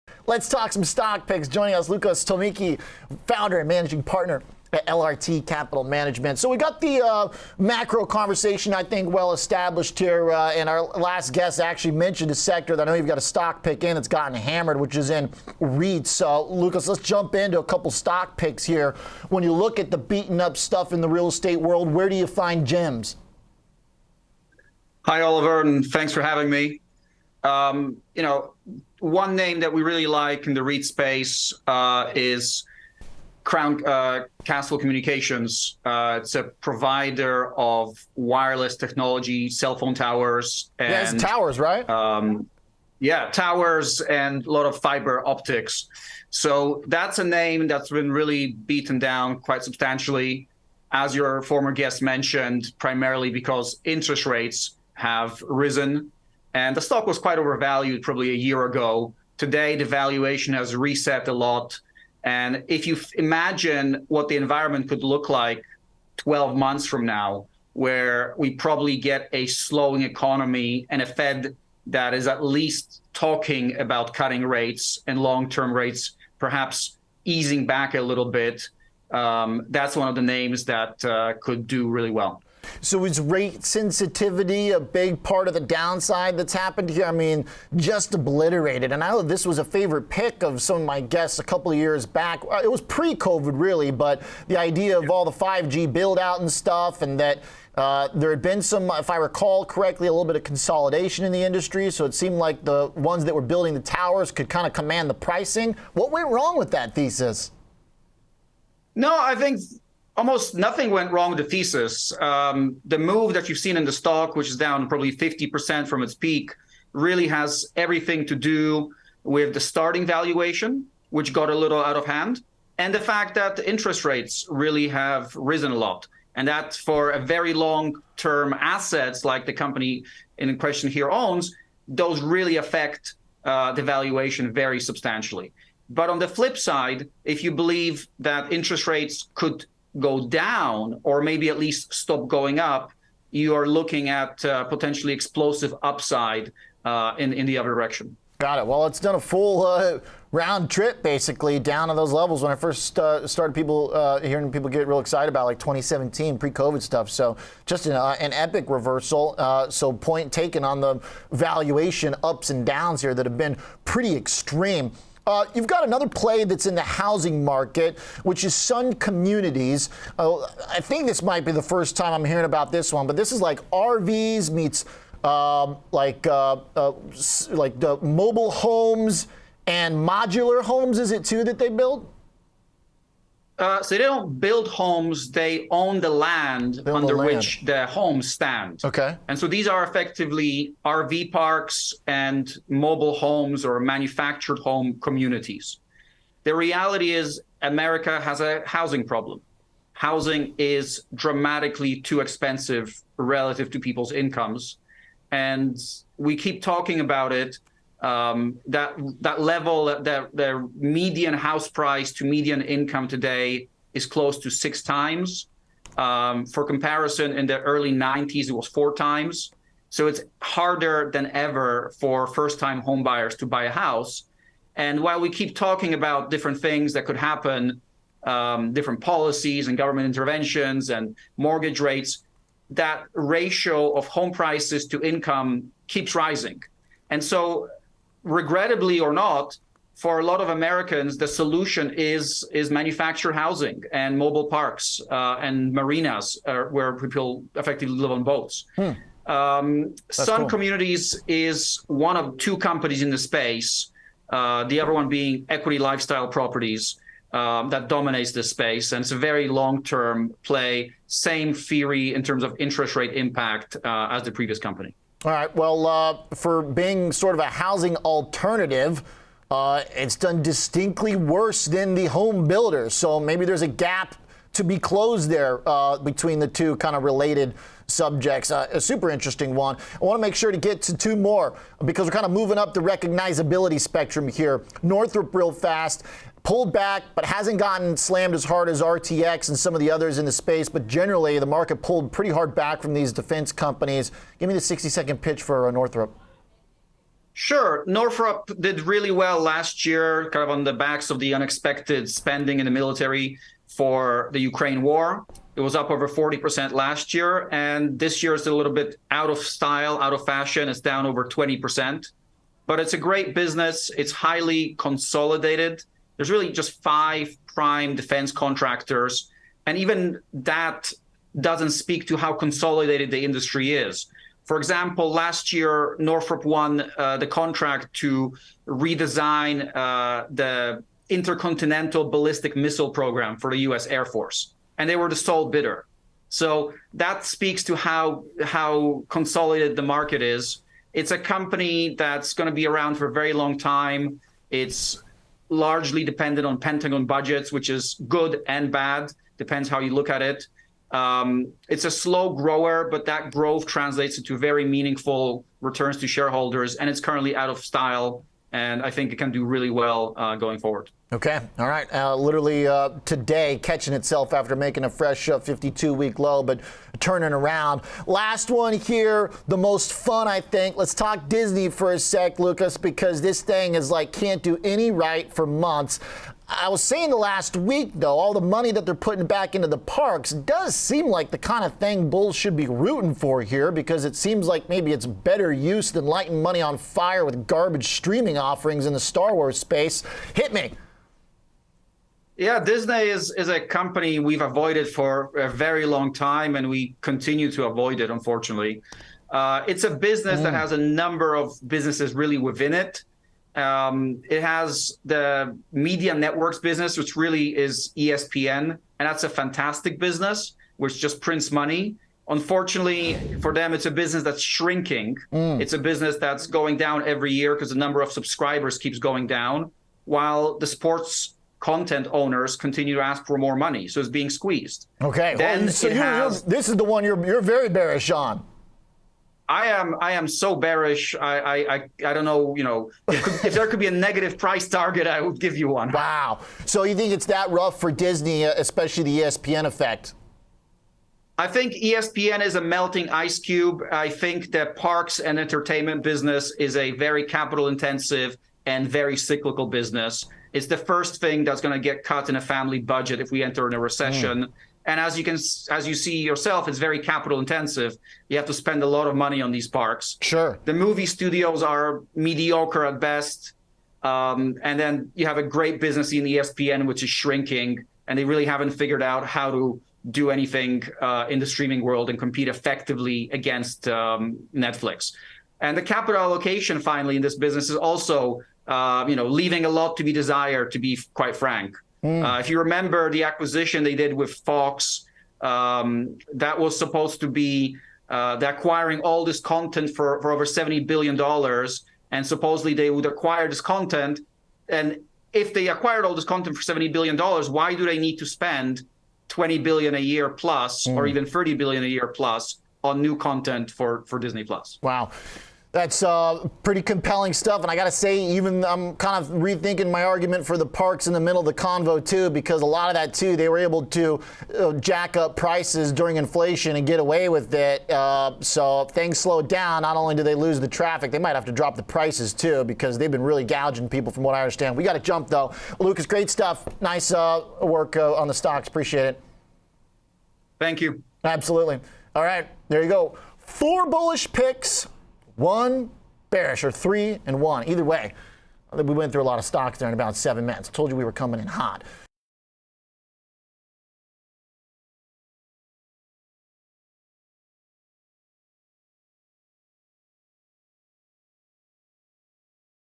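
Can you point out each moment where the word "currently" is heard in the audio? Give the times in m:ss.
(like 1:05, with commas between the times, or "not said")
5:56.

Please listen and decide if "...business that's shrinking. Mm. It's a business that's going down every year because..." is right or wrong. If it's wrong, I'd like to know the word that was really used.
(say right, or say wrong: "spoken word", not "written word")
right.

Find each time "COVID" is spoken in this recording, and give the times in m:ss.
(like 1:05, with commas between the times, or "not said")
1:32, 2:36.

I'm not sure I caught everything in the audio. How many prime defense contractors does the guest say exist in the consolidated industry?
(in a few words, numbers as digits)
5.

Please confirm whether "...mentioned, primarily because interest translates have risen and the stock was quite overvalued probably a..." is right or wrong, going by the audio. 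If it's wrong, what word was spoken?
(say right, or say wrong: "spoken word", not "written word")
wrong: "rates", not "translates".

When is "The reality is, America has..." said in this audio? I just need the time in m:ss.
3:16.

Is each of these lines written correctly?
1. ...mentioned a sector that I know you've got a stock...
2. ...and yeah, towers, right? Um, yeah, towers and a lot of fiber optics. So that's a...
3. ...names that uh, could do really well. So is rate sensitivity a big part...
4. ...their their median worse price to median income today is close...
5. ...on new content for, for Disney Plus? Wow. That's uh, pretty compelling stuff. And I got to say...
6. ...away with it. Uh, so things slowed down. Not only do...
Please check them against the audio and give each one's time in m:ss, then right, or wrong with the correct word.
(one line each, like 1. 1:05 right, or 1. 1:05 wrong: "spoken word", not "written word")
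1. 0:11 right
2. 0:40 right
3. 1:20 right
4. 3:30 wrong: "house", not "worse"
5. 8:22 right
6. 8:36 right.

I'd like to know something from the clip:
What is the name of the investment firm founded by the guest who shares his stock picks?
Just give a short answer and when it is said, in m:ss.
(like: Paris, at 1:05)
LRT Capital Management, at 0:04.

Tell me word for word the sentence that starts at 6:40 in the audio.
that has a number of businesses really within it.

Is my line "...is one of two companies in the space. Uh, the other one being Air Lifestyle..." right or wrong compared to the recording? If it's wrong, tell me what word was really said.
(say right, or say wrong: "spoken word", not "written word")
wrong: "Equity", not "Air".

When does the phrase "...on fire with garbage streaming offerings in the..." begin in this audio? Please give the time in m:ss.
6:26.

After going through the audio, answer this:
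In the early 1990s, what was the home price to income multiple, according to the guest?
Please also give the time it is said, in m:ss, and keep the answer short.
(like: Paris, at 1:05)
4 times, at 3:38.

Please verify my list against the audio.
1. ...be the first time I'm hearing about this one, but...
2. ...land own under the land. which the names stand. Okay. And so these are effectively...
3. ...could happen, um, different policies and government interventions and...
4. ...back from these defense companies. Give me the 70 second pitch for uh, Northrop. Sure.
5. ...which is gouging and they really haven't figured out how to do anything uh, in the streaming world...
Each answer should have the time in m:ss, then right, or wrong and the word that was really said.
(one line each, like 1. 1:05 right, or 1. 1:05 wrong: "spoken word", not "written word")
1. 2:51 right
2. 3:06 wrong: "homes", not "names"
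3. 3:47 right
4. 4:52 wrong: "60", not "70"
5. 7:46 wrong: "shrinking", not "gouging".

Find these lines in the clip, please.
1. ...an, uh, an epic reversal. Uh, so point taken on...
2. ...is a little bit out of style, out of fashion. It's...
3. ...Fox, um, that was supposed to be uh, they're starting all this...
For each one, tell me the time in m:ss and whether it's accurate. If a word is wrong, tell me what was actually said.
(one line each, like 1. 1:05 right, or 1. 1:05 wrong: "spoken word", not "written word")
1. 2:37 right
2. 5:08 right
3. 8:04 wrong: "acquiring", not "starting".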